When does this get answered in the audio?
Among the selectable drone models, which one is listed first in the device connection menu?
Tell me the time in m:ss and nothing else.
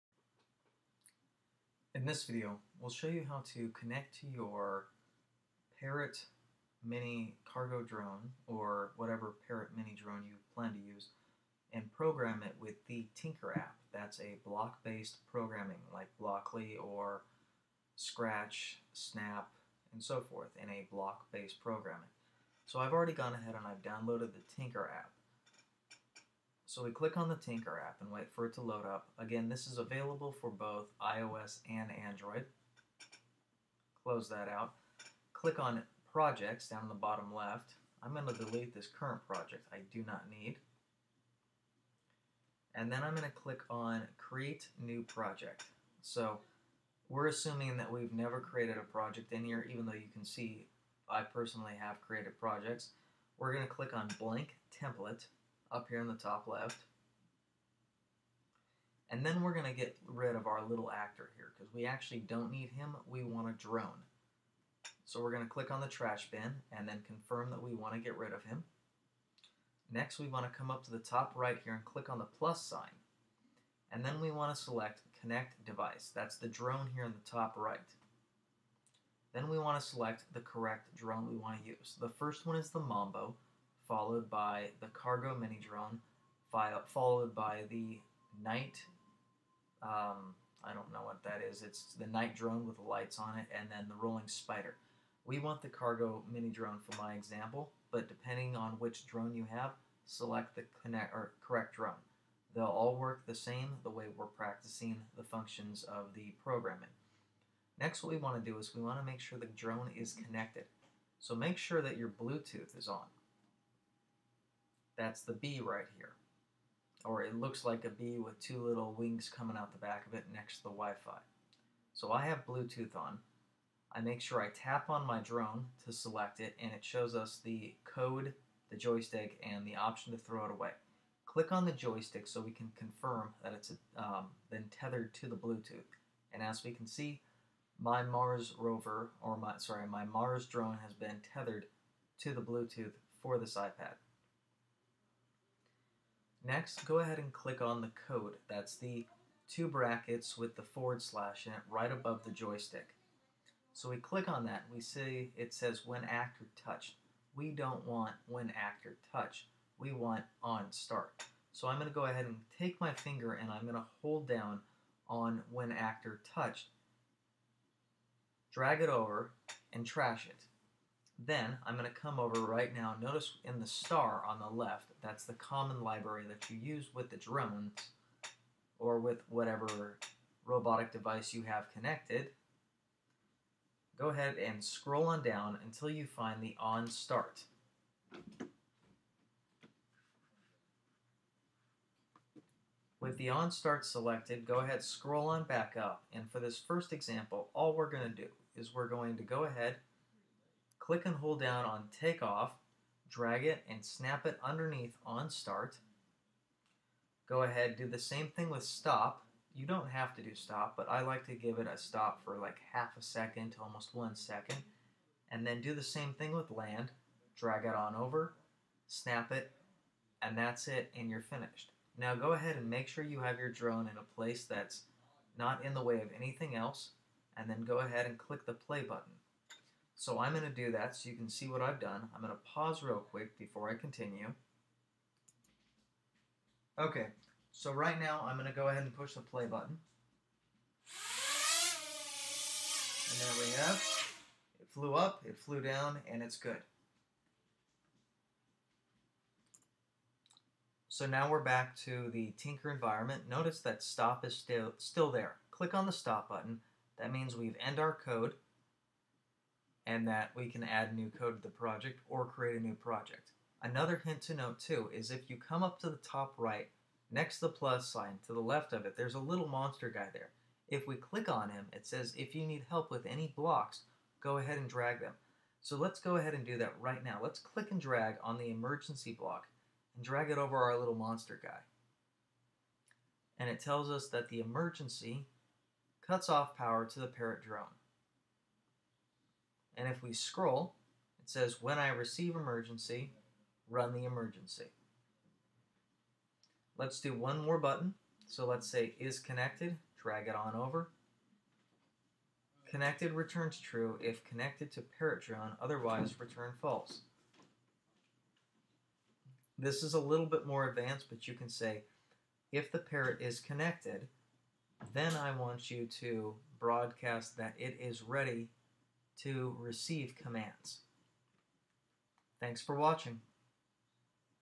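1:22.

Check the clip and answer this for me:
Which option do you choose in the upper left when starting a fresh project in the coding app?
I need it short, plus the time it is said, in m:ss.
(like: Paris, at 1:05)
Blank Template, at 0:54.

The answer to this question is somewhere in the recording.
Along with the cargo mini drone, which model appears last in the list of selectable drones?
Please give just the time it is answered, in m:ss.
1:34.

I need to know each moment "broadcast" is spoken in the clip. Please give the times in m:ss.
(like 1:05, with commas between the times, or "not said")
5:16.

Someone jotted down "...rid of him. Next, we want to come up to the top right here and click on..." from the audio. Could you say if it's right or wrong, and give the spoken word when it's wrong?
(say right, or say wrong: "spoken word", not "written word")
right.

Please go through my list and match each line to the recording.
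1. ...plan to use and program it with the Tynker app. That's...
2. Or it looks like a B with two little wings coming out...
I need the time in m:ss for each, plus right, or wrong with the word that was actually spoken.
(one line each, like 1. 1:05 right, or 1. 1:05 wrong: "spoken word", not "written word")
1. 0:10 right
2. 1:57 right.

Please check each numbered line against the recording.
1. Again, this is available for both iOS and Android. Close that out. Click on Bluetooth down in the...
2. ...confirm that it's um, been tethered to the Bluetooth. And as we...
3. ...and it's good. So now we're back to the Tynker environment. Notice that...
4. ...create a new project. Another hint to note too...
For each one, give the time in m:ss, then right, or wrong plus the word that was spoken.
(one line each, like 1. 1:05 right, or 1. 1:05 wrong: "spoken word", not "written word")
1. 0:29 wrong: "Projects", not "Bluetooth"
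2. 2:12 right
3. 4:06 right
4. 4:22 right.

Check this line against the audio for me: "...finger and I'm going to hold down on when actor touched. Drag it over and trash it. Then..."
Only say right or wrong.
right.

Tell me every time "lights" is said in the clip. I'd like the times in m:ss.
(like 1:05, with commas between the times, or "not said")
1:32.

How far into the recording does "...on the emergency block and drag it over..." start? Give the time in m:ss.
4:38.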